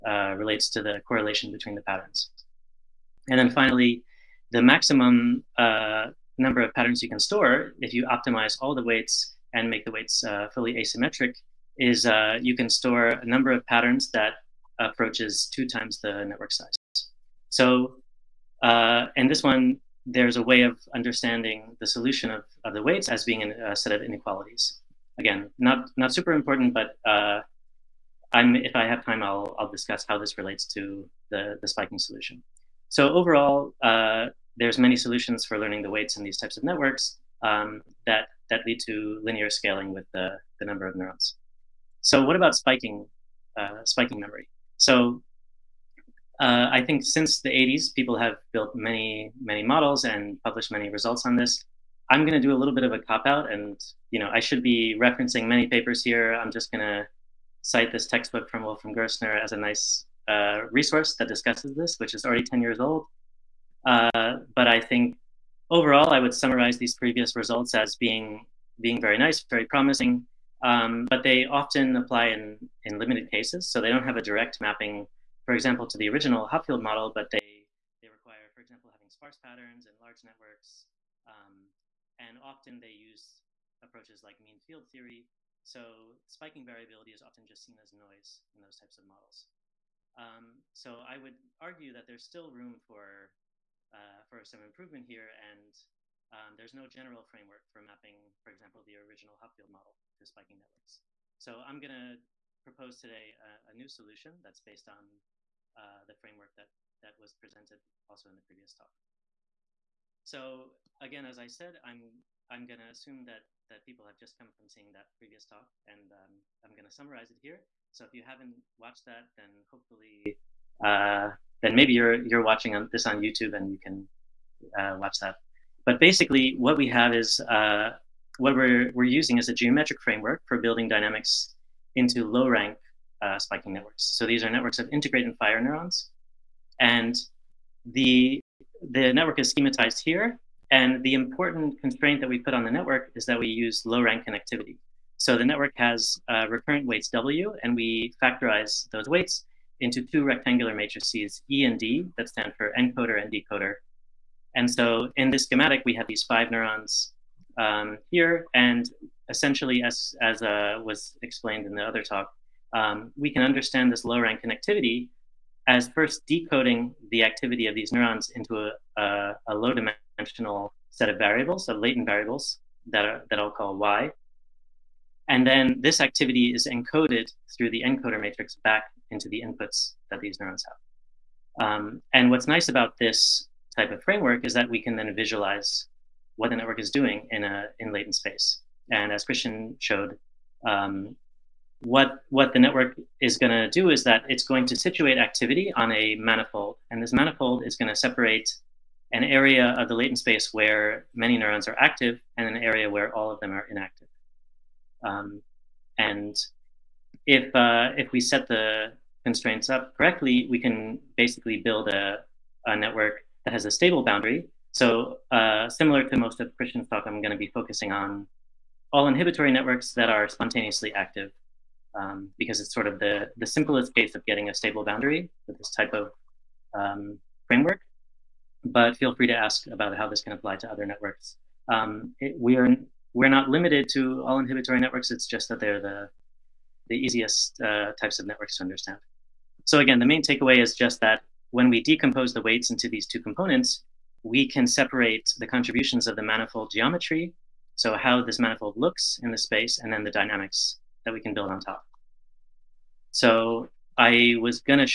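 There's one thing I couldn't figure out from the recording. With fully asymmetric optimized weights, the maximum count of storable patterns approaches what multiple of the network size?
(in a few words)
2 times.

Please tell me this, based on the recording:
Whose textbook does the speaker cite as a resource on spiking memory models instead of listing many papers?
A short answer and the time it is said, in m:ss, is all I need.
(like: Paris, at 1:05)
Wolfram Gerstner, at 0:58.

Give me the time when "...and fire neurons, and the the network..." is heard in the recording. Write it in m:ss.
2:15.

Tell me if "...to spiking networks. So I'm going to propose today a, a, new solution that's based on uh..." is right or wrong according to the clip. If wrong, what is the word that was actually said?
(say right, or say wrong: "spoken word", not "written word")
right.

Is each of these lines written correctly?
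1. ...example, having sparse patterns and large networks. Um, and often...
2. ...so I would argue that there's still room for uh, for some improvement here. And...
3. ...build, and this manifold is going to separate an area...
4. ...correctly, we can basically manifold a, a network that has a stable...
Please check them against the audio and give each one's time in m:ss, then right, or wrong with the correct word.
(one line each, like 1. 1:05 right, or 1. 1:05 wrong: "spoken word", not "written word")
1. 1:18 right
2. 1:30 right
3. 3:16 wrong: "manifold", not "build"
4. 3:29 wrong: "build", not "manifold".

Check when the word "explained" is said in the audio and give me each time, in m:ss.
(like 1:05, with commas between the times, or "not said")
2:41.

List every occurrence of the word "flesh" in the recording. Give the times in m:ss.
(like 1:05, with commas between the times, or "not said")
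not said.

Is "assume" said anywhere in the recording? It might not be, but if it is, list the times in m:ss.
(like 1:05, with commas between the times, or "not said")
1:52.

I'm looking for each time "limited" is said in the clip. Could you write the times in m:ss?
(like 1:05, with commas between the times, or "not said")
1:12, 3:53.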